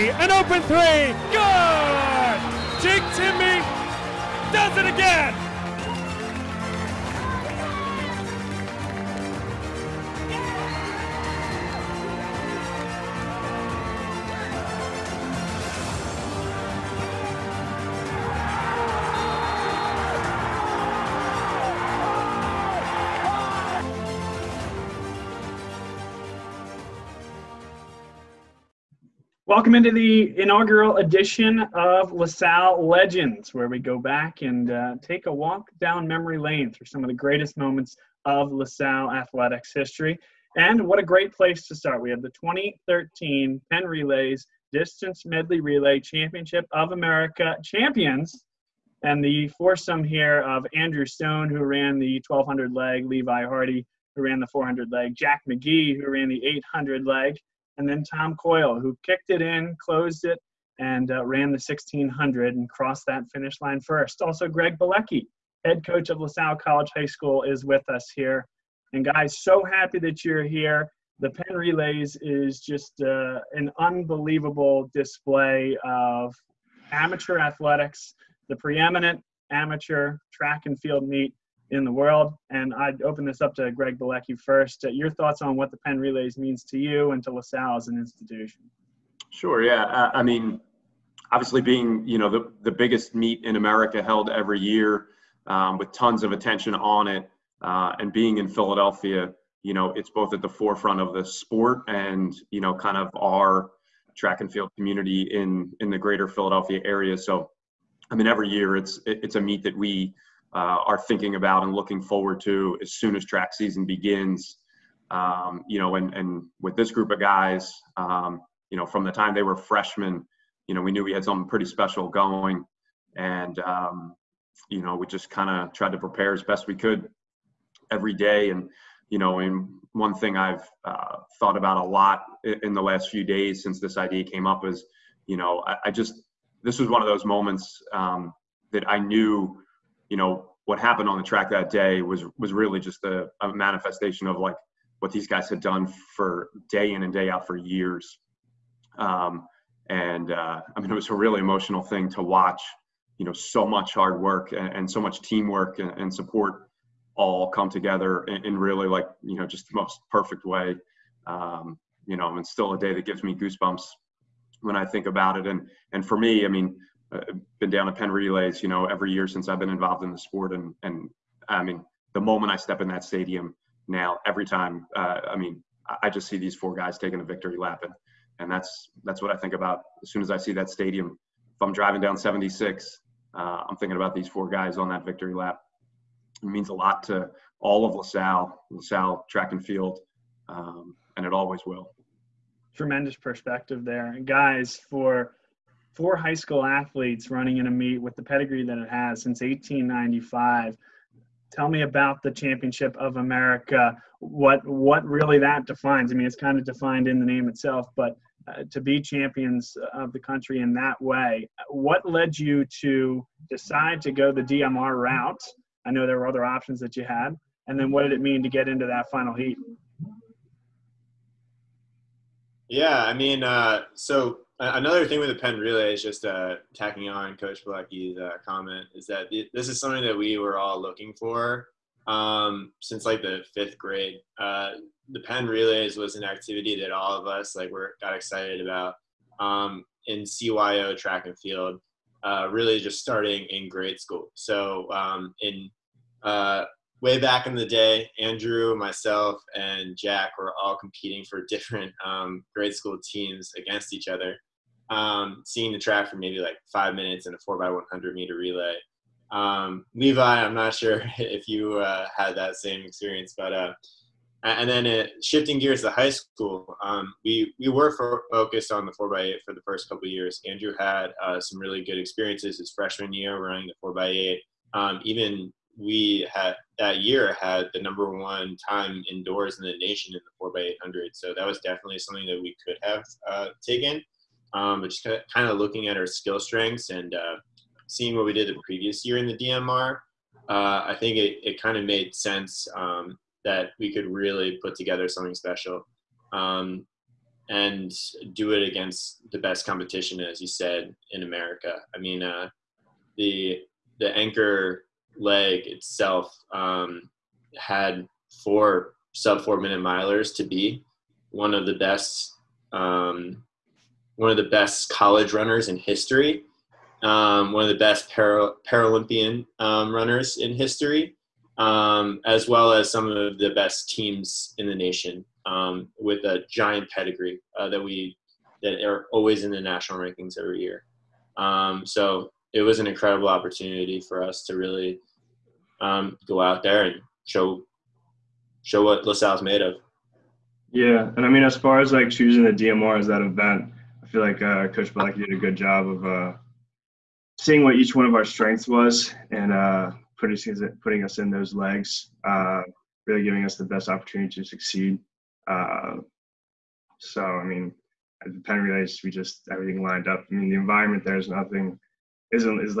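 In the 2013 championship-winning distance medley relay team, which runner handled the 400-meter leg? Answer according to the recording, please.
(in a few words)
Levi Hardy.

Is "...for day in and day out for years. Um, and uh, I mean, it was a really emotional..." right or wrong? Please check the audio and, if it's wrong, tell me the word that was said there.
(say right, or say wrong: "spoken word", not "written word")
right.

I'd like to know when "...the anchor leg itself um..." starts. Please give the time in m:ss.
5:03.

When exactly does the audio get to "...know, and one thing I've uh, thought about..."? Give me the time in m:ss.
2:09.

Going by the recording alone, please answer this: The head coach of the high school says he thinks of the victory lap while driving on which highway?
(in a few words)
76.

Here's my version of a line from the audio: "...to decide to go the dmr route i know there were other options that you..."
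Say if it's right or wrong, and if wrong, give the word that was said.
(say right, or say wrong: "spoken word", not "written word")
right.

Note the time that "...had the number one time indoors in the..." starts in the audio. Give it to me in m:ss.
4:37.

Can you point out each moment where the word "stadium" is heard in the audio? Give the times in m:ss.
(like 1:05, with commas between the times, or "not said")
2:53, 3:00.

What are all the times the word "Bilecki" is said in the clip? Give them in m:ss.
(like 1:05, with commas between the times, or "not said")
1:04, 1:23, 3:47.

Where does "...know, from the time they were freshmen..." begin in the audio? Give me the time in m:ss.
1:58.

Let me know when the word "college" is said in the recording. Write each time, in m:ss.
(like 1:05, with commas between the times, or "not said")
1:06, 5:14.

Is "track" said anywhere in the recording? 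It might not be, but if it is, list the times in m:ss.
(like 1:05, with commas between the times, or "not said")
1:20, 1:44, 1:53, 2:21, 3:09, 4:00, 4:15.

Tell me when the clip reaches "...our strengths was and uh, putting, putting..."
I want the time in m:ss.
5:48.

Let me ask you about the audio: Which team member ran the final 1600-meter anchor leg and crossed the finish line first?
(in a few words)
Tom Coyle.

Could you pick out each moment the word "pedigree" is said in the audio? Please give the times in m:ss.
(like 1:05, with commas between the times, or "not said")
3:18, 5:26.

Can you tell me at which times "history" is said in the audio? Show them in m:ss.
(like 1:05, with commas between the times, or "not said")
0:39, 5:15, 5:20.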